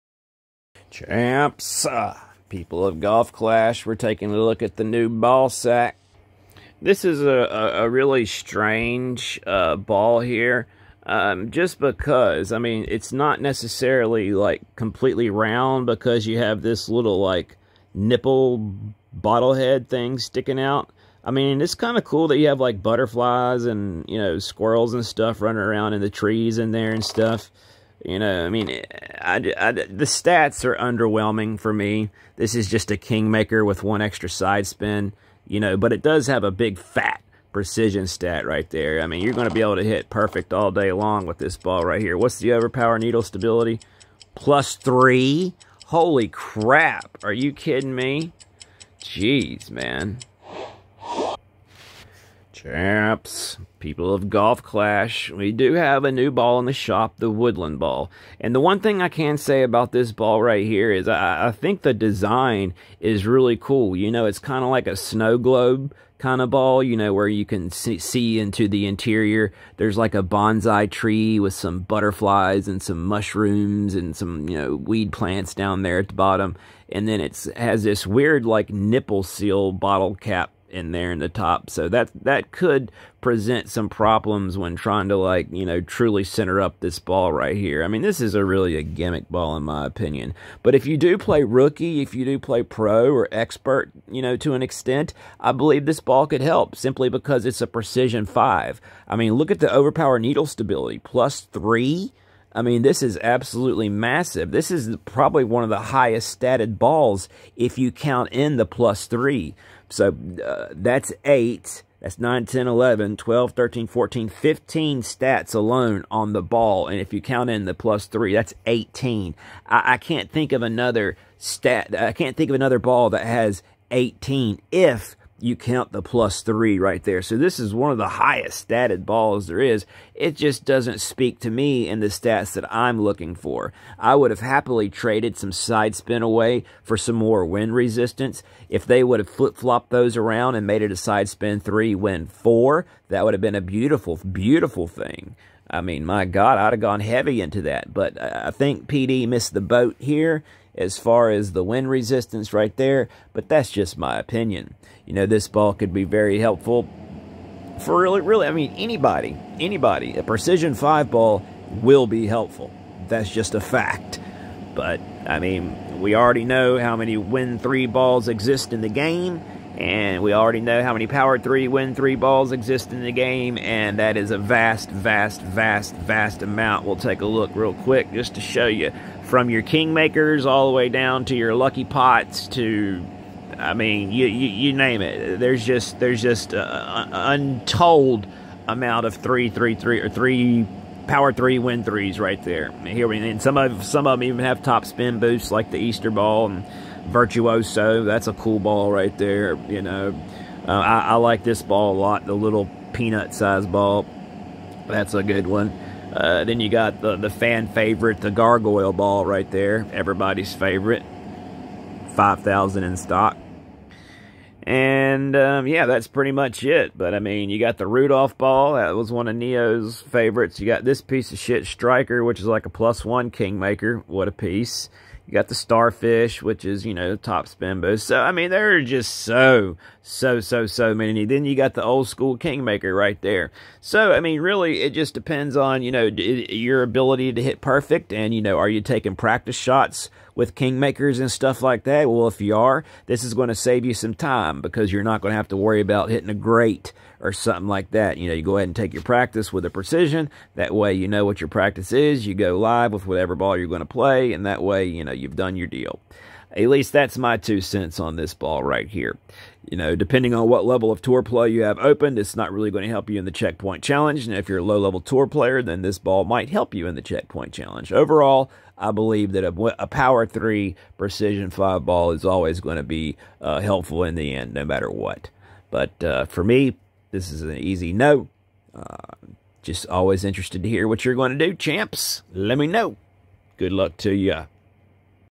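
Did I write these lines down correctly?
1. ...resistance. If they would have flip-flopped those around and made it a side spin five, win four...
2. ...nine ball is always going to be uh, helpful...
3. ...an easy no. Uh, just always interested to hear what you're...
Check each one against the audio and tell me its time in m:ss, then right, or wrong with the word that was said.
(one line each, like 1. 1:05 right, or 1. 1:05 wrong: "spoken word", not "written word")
1. 2:17 wrong: "three", not "five"
2. 4:31 wrong: "five", not "nine"
3. 4:37 right.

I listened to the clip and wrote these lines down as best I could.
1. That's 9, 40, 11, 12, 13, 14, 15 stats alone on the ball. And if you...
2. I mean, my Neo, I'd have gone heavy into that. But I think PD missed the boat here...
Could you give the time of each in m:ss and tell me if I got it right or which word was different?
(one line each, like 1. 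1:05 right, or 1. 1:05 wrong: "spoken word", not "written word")
1. 1:51 wrong: "10", not "40"
2. 2:25 wrong: "God", not "Neo".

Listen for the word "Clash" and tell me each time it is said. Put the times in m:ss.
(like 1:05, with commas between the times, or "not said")
0:03, 0:54.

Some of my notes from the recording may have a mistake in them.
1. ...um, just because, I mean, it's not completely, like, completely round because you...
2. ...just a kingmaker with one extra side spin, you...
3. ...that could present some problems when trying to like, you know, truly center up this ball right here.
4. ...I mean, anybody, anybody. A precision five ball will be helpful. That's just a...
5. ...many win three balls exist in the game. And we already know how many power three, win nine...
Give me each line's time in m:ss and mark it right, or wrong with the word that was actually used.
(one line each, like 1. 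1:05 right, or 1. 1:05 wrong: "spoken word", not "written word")
1. 0:11 wrong: "necessarily", not "completely"
2. 0:32 right
3. 1:22 right
4. 2:38 right
5. 2:46 wrong: "three", not "nine".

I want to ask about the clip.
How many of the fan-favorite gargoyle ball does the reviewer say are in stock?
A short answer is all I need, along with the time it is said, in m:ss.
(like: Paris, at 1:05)
5,000, at 3:32.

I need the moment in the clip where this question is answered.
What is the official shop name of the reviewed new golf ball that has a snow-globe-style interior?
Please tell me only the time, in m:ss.
0:57.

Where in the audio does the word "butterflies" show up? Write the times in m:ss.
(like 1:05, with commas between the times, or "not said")
0:22, 1:11.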